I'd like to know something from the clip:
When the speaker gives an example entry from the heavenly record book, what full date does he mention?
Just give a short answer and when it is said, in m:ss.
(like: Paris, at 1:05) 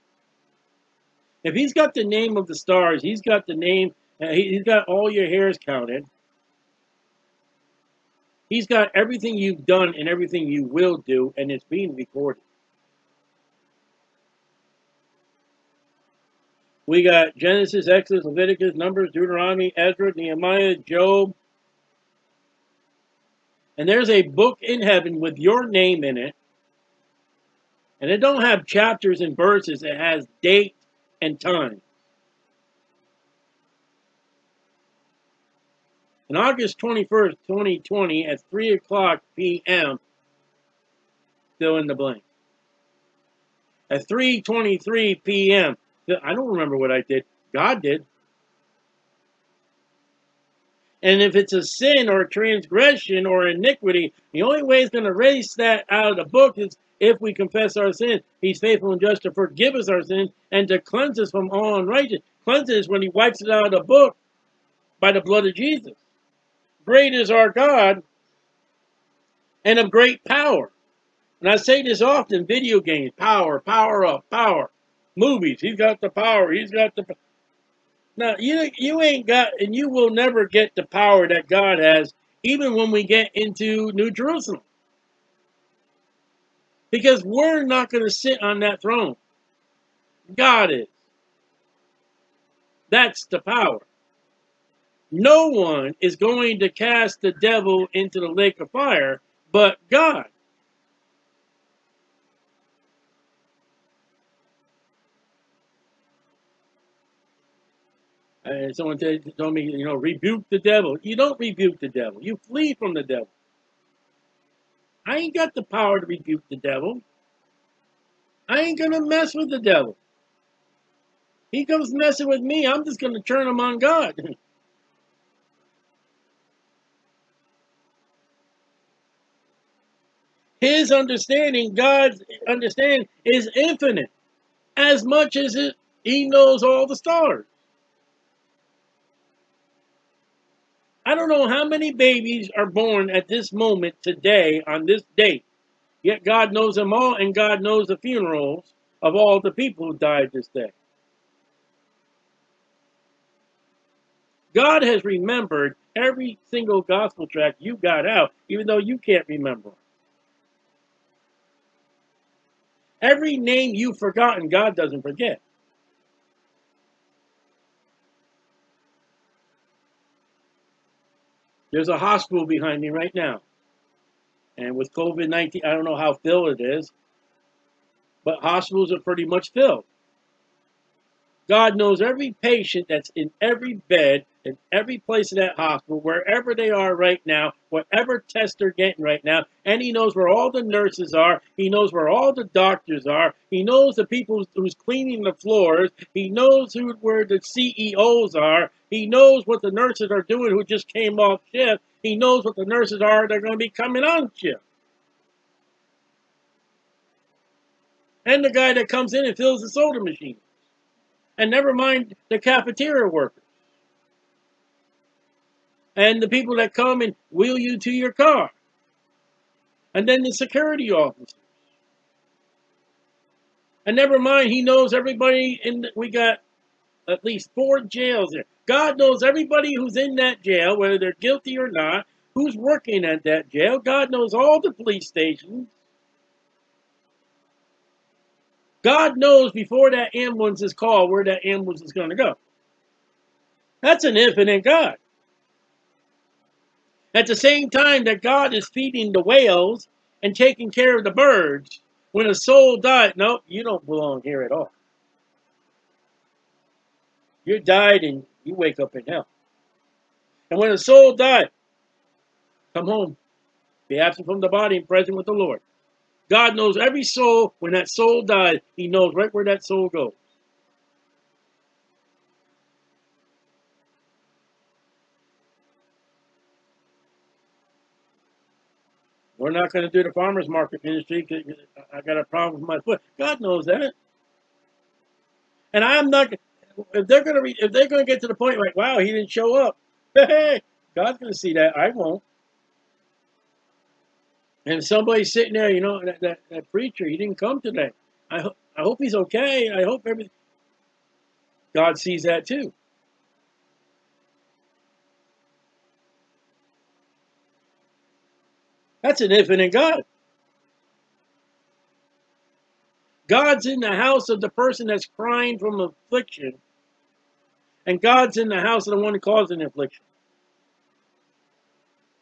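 August 21st, 2020, at 0:36.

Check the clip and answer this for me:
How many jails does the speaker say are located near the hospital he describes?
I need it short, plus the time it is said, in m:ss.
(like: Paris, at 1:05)
4, at 3:47.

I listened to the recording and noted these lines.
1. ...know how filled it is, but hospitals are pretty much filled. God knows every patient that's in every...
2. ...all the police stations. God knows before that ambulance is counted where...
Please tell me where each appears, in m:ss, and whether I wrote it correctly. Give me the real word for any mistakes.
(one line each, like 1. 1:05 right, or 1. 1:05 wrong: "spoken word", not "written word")
1. 2:55 right
2. 3:54 wrong: "called", not "counted".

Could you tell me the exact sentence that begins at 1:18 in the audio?
Now, you, you ain't got, and you will never get the power that God has, even when we get into New Jerusalem.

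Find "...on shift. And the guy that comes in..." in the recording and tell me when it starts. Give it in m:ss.
3:24.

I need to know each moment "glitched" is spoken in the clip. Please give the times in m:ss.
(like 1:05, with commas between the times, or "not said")
not said.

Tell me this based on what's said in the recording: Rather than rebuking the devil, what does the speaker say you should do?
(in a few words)
Flee.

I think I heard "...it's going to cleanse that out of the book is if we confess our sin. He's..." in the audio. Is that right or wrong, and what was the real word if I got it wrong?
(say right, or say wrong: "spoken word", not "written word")
wrong: "erase", not "cleanse".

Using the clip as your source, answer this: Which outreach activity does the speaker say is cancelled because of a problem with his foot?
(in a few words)
Farmer's market ministry.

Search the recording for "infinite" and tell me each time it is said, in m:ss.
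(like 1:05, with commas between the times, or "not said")
2:13, 4:04, 5:09.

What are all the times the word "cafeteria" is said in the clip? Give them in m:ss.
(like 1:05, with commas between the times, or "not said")
3:32.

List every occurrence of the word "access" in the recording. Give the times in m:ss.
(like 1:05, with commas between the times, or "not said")
not said.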